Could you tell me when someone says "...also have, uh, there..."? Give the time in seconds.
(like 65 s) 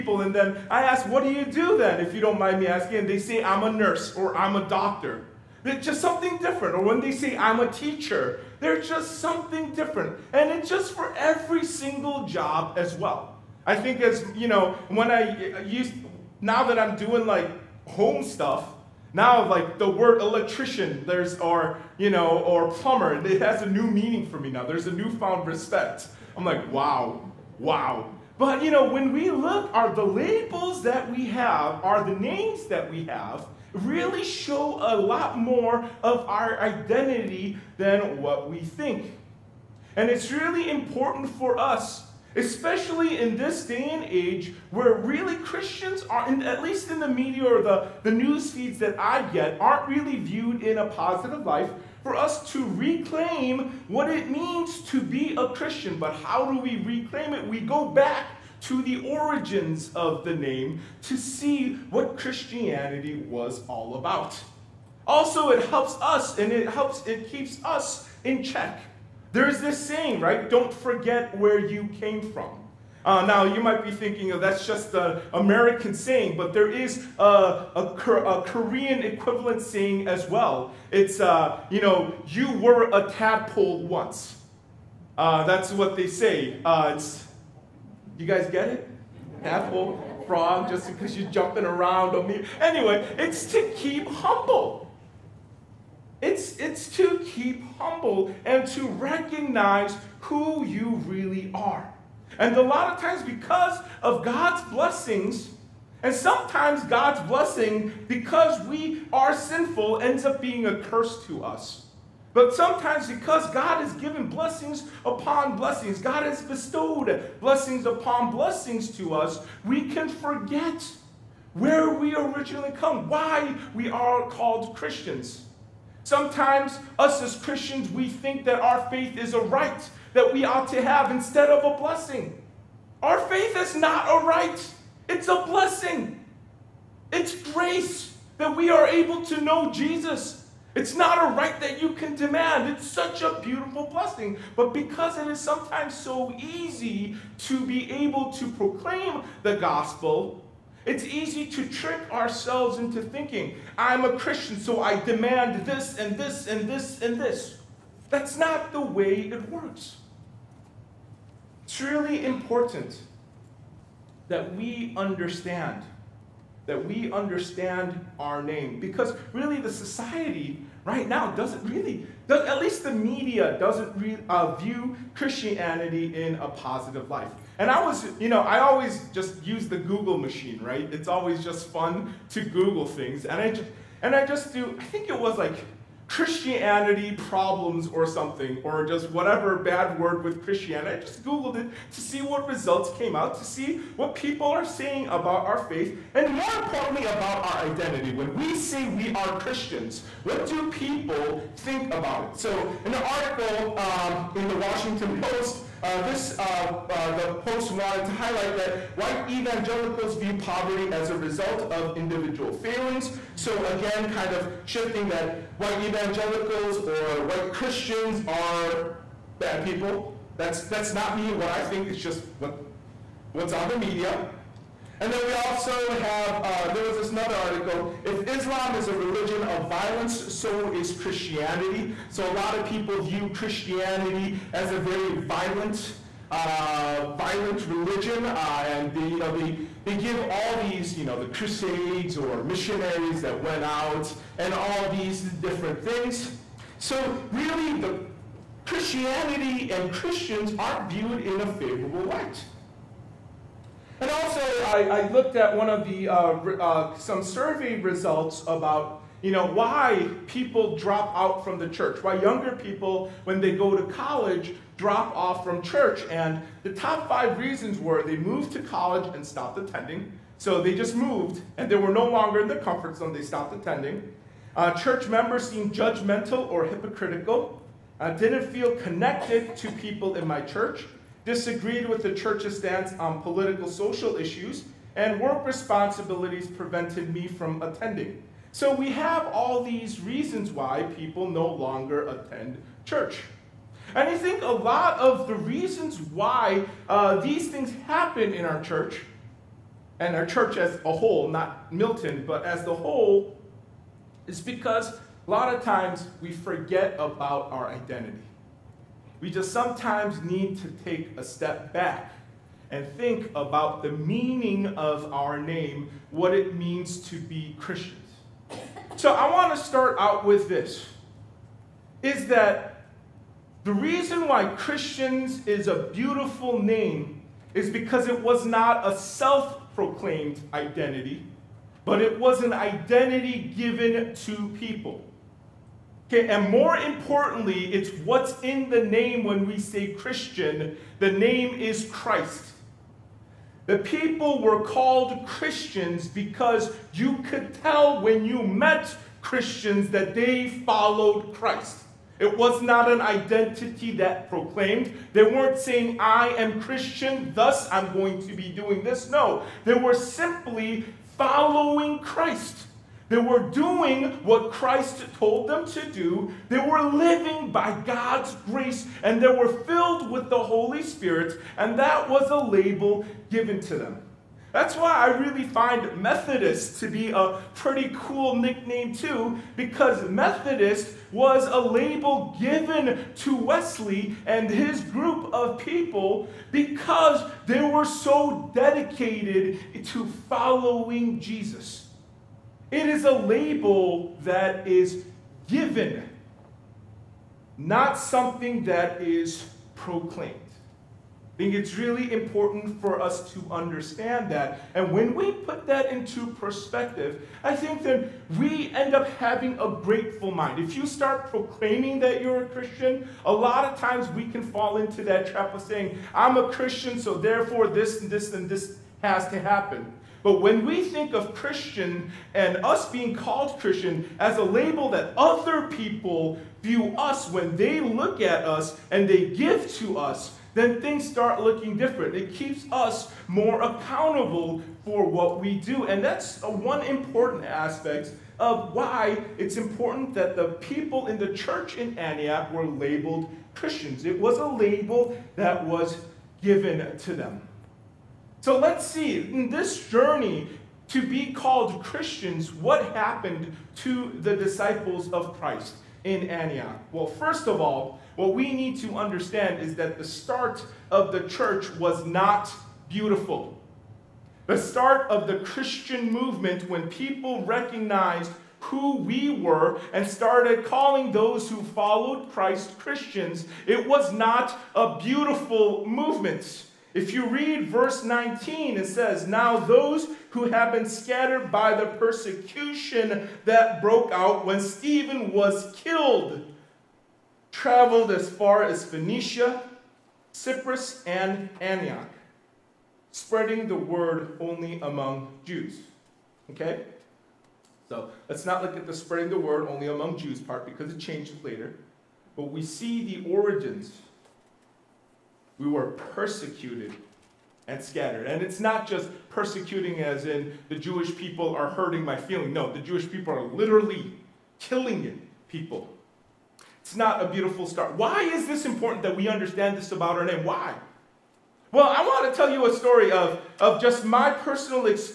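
225 s.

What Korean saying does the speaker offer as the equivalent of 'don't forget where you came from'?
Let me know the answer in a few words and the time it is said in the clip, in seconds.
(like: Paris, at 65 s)
You were a tadpole once, at 82 s.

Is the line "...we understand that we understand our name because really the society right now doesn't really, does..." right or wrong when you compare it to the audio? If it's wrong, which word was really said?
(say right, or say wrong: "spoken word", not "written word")
right.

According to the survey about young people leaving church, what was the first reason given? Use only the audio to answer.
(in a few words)
They moved to college.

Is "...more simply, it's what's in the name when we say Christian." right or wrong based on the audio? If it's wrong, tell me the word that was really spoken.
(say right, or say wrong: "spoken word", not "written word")
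wrong: "importantly", not "simply".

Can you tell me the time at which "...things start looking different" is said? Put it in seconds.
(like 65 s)
430 s.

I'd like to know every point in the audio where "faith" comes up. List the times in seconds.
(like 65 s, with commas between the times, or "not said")
128 s, 133 s, 195 s.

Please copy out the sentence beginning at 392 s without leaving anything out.
It is a label that is given, not something that is proclaimed.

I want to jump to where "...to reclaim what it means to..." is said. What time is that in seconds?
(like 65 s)
52 s.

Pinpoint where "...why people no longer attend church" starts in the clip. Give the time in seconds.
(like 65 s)
290 s.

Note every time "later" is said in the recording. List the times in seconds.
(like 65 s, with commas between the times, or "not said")
501 s.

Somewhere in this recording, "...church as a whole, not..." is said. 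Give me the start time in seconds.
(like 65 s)
300 s.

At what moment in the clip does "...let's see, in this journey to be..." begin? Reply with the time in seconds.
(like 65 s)
448 s.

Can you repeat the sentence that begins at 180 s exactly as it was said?
It's always just fun to Google things.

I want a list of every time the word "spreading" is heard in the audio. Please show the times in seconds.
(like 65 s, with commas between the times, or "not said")
493 s, 498 s.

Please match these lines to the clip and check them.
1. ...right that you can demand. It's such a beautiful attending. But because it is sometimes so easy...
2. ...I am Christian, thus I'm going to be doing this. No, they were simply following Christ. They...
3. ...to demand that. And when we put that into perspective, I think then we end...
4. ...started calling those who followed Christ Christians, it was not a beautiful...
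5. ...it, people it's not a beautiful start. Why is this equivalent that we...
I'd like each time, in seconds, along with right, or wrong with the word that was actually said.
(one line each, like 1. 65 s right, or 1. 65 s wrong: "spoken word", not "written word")
1. 141 s wrong: "blessing", not "attending"
2. 355 s right
3. 403 s wrong: "understand", not "demand"
4. 470 s right
5. 515 s wrong: "important", not "equivalent".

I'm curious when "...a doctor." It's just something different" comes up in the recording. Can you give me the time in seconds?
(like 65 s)
4 s.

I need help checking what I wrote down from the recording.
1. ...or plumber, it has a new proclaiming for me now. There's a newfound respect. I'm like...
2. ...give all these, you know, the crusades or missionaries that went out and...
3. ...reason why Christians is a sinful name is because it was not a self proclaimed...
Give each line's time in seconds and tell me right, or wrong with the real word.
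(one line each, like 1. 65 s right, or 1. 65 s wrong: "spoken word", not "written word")
1. 22 s wrong: "meaning", not "proclaiming"
2. 239 s right
3. 323 s wrong: "beautiful", not "sinful".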